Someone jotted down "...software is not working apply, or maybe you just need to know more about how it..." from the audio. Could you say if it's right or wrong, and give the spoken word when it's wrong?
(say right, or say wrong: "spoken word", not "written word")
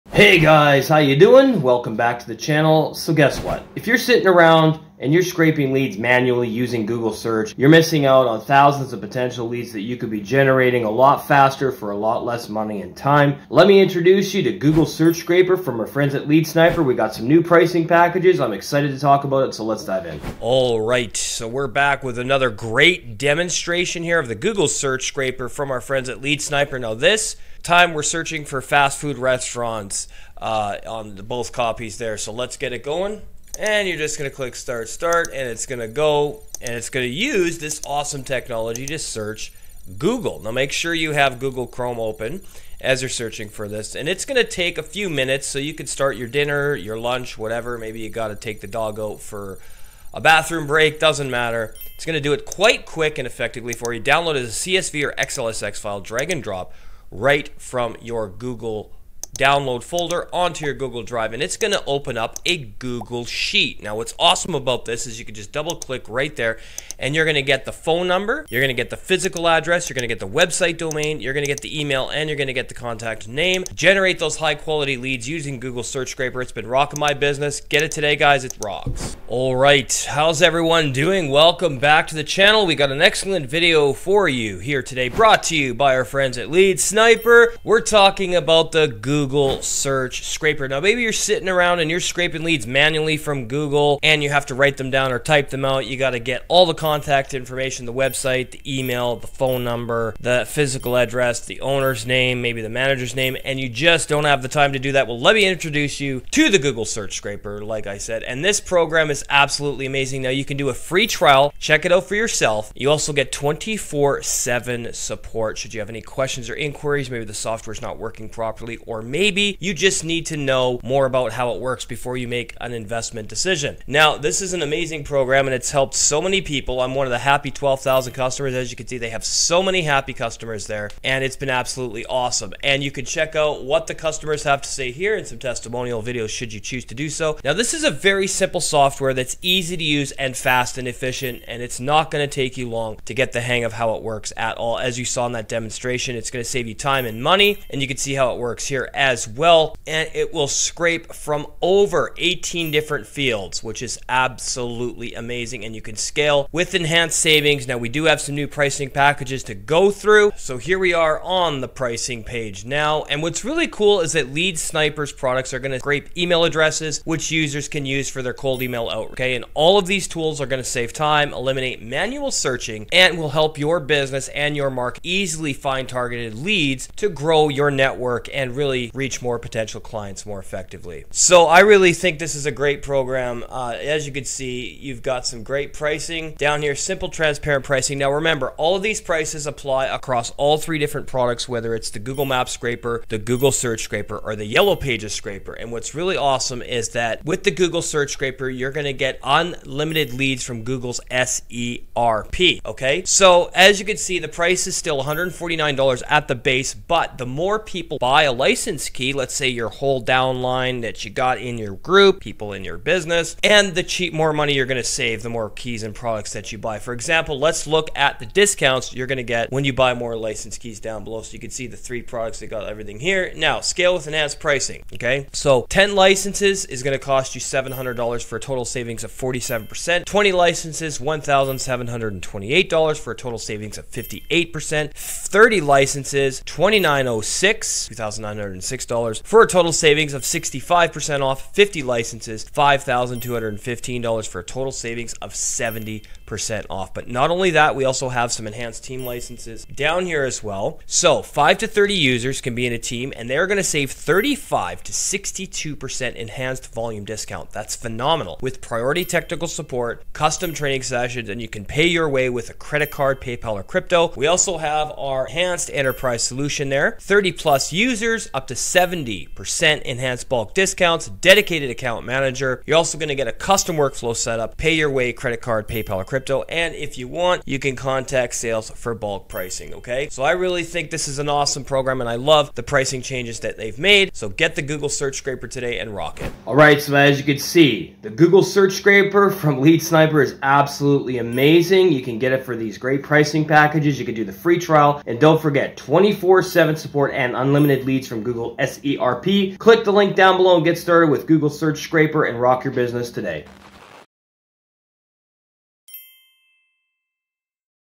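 wrong: "properly", not "apply".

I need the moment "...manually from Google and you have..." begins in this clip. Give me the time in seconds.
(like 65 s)
92 s.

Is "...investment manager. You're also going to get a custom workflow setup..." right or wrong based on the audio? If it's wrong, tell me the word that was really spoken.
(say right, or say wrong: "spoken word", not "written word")
wrong: "account", not "investment".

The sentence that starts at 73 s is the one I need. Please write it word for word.
Generate those high quality leads using Google Search Scraper.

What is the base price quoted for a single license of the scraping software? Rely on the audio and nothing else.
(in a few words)
$149.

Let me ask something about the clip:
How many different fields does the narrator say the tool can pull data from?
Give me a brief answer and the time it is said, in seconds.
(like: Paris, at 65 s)
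18, at 152 s.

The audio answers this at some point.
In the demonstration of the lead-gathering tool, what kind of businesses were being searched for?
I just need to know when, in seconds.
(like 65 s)
28 s.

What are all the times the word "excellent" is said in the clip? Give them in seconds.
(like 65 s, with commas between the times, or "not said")
83 s.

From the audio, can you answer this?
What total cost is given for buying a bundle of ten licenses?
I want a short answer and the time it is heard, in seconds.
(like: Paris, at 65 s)
$700, at 227 s.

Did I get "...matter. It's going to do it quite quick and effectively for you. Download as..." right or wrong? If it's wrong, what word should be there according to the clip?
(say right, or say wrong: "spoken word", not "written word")
right.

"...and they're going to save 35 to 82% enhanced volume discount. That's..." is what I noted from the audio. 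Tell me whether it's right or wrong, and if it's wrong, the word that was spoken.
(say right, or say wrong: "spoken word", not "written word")
wrong: "62", not "82".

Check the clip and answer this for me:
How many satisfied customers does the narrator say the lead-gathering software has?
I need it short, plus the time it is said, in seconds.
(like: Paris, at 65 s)
12,000, at 127 s.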